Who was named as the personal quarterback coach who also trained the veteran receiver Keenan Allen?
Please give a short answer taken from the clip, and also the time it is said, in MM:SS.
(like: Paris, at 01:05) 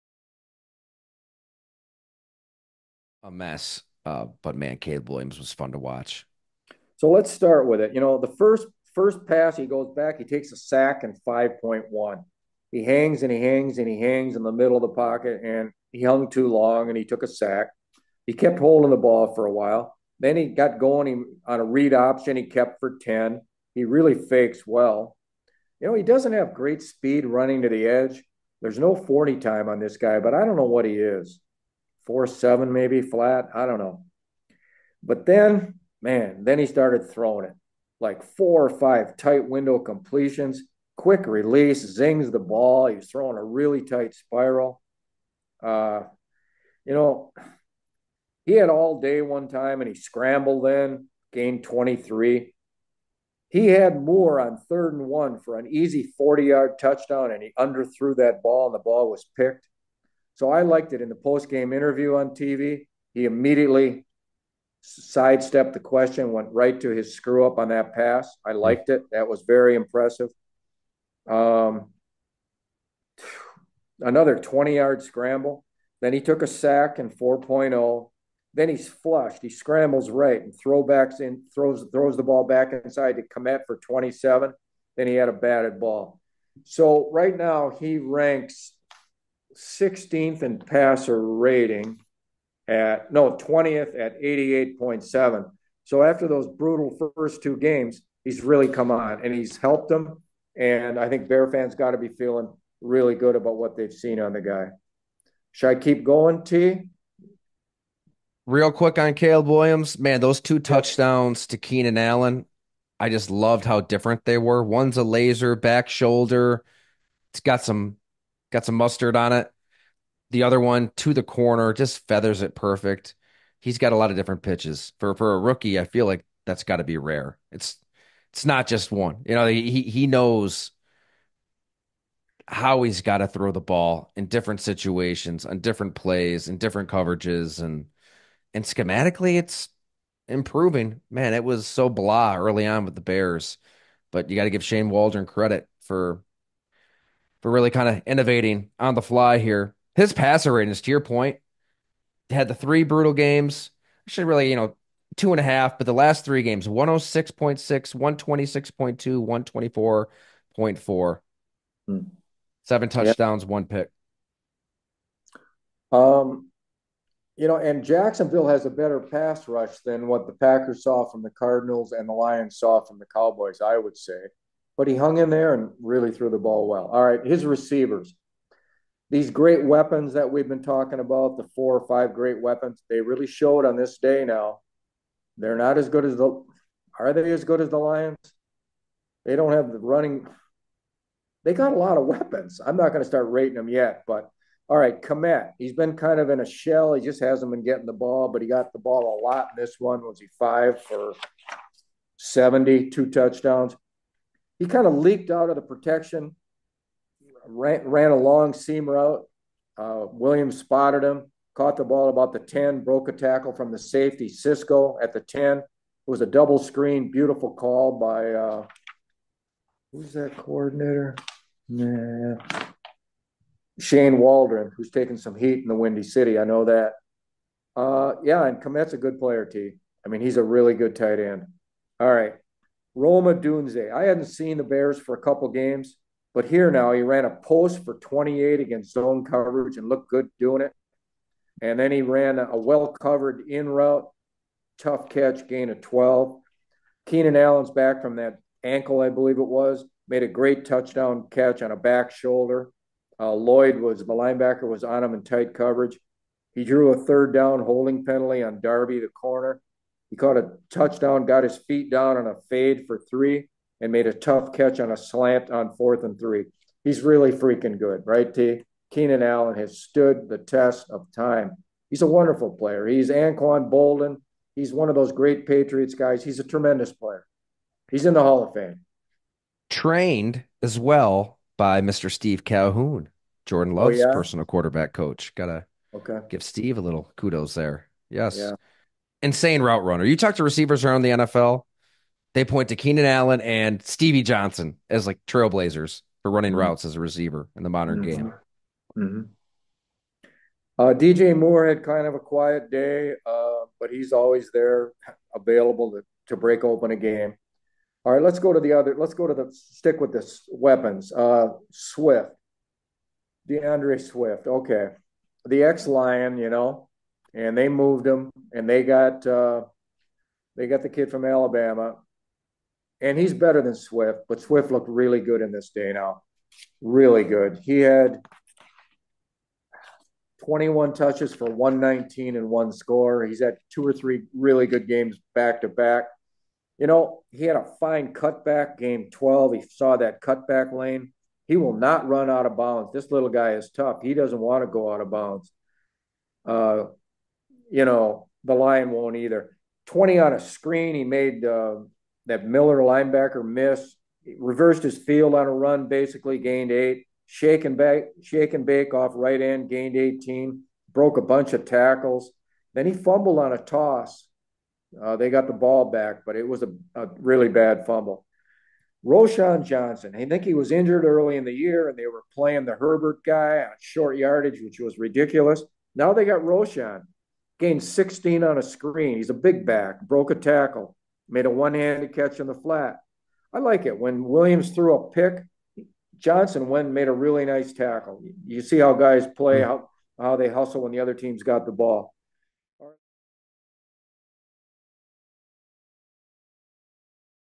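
Steve Calhoun, at 04:42.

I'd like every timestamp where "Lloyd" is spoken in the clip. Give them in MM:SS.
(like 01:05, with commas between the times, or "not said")
04:13.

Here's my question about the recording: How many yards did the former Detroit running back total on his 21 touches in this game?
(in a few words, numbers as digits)
119.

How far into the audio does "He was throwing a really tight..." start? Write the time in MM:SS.
00:42.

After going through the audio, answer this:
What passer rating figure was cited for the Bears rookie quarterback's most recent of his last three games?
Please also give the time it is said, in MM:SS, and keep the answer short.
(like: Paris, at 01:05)
124.4, at 02:40.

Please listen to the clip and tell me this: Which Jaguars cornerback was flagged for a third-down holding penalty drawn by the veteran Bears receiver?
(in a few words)
Darby.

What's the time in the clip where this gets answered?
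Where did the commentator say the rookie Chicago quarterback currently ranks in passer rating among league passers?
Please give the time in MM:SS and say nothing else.
01:33.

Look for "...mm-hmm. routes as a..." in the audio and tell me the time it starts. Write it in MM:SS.
04:56.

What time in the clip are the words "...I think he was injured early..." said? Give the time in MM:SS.
06:10.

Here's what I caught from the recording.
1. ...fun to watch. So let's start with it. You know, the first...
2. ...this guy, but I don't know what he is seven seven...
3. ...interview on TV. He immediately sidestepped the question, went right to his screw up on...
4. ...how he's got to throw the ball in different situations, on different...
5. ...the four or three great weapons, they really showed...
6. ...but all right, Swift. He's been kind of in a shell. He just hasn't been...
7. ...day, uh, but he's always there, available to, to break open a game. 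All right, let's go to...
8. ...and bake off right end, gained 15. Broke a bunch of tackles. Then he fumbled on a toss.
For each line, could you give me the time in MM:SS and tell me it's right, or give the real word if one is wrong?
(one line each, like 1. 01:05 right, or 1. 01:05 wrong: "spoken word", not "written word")
1. 00:05 right
2. 00:29 wrong: "four", not "seven"
3. 01:01 right
4. 02:12 right
5. 03:01 wrong: "five", not "three"
6. 03:14 wrong: "Kmet", not "Swift"
7. 05:02 right
8. 05:58 wrong: "18", not "15".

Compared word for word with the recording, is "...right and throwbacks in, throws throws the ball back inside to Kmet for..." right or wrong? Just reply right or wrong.
right.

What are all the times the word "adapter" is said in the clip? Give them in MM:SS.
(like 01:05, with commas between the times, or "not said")
not said.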